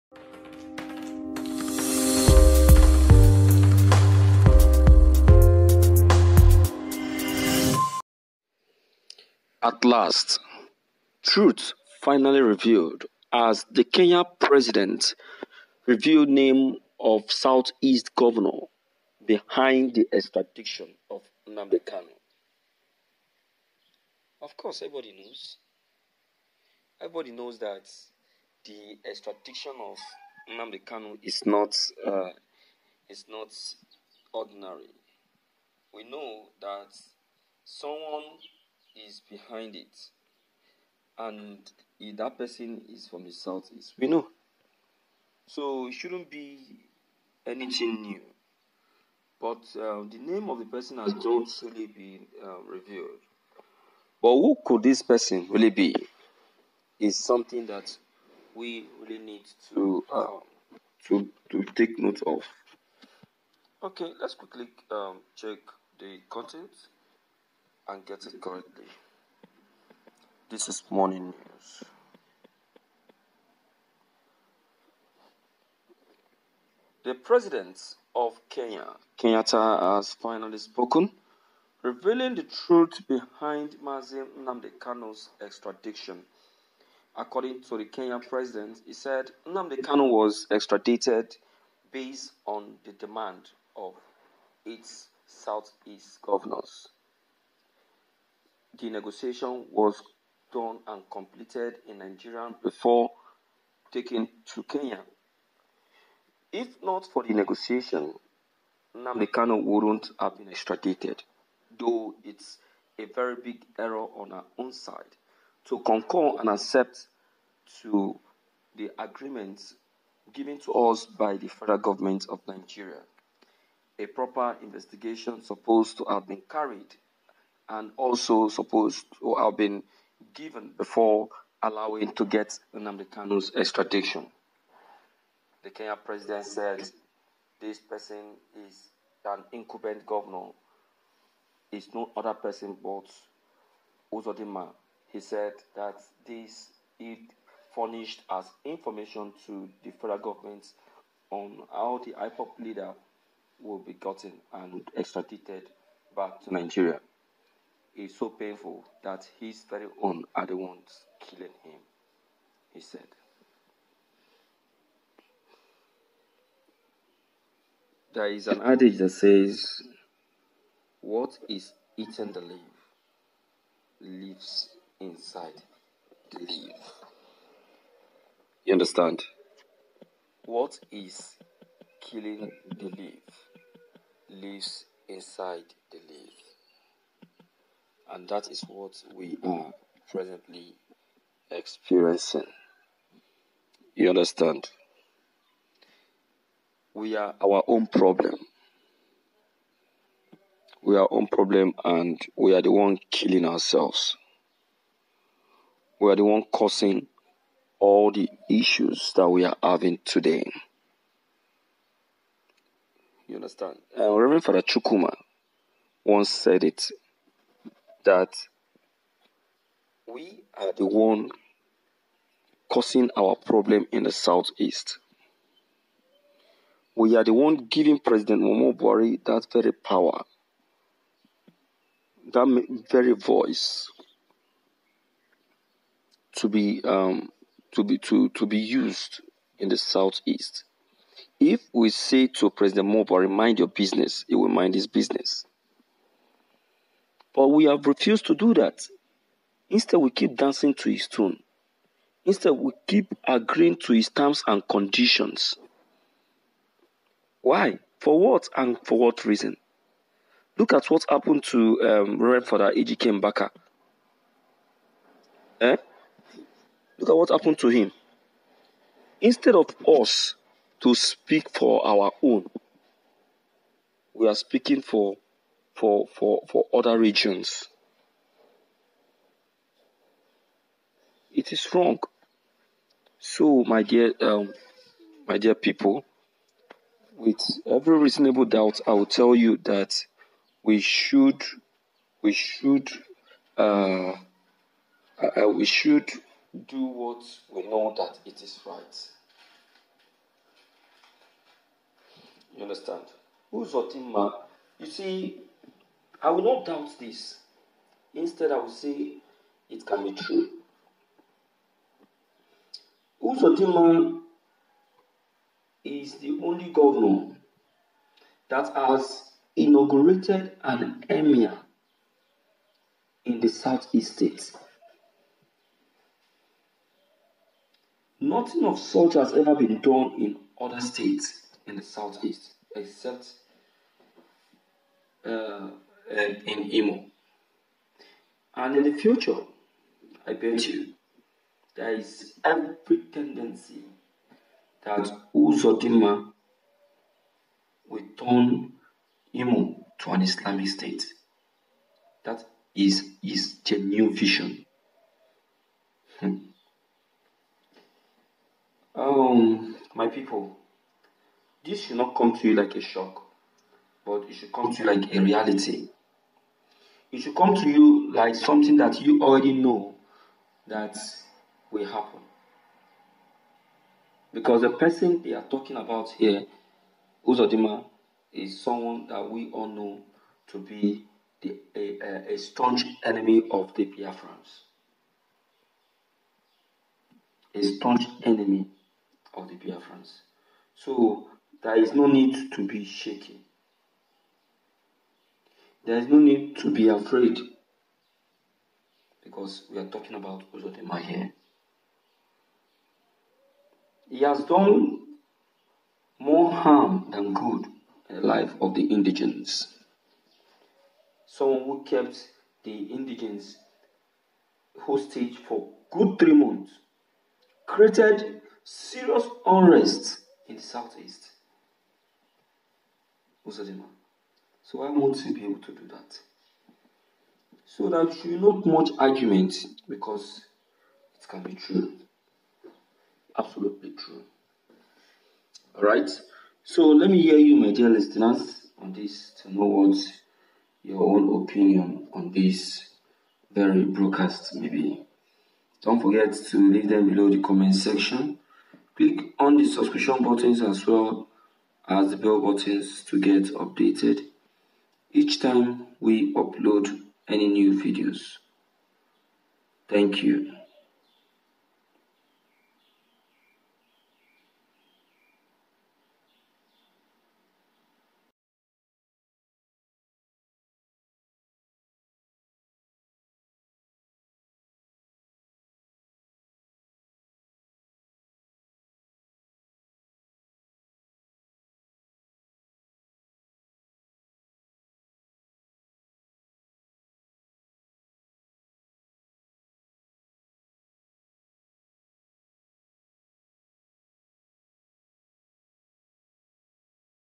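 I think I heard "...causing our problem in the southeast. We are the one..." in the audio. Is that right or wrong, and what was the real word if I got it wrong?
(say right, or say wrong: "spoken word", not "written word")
right.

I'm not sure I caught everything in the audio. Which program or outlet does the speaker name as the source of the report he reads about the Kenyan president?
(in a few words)
Morning News.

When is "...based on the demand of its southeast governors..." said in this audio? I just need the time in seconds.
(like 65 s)
91 s.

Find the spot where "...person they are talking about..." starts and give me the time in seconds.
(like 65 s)
374 s.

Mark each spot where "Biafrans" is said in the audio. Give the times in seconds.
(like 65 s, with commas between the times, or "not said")
383 s, 389 s.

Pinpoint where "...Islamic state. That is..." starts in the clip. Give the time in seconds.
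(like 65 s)
350 s.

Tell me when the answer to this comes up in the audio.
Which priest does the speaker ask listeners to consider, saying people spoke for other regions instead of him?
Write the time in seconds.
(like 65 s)
262 s.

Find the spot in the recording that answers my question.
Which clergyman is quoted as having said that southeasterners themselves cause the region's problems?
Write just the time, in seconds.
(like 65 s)
214 s.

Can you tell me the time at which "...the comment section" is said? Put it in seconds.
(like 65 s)
447 s.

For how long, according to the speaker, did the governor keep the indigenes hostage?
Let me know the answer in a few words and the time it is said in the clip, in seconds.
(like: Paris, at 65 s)
3 months, at 416 s.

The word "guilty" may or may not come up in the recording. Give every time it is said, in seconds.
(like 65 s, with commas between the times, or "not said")
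not said.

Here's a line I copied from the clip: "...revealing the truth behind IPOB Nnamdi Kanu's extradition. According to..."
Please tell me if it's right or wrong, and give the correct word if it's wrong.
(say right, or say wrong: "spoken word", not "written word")
wrong: "Mazim", not "IPOB".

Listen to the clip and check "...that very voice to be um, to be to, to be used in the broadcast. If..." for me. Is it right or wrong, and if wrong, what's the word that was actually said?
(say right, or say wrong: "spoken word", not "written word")
wrong: "southeast", not "broadcast".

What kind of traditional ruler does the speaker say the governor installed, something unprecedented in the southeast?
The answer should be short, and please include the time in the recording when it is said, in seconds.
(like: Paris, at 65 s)
an emir, at 319 s.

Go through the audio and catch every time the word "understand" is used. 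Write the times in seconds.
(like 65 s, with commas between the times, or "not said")
178 s, 194 s, 213 s, 302 s.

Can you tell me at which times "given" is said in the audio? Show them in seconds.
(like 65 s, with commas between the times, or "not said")
120 s, 130 s.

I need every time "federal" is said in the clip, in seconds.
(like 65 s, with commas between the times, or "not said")
121 s, 149 s.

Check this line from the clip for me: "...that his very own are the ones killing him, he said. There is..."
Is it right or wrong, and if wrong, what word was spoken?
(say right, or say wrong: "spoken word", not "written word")
right.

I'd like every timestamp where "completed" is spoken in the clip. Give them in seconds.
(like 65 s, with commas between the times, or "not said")
101 s.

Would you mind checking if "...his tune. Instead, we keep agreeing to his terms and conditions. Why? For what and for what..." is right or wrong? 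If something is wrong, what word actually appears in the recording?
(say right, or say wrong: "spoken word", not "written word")
right.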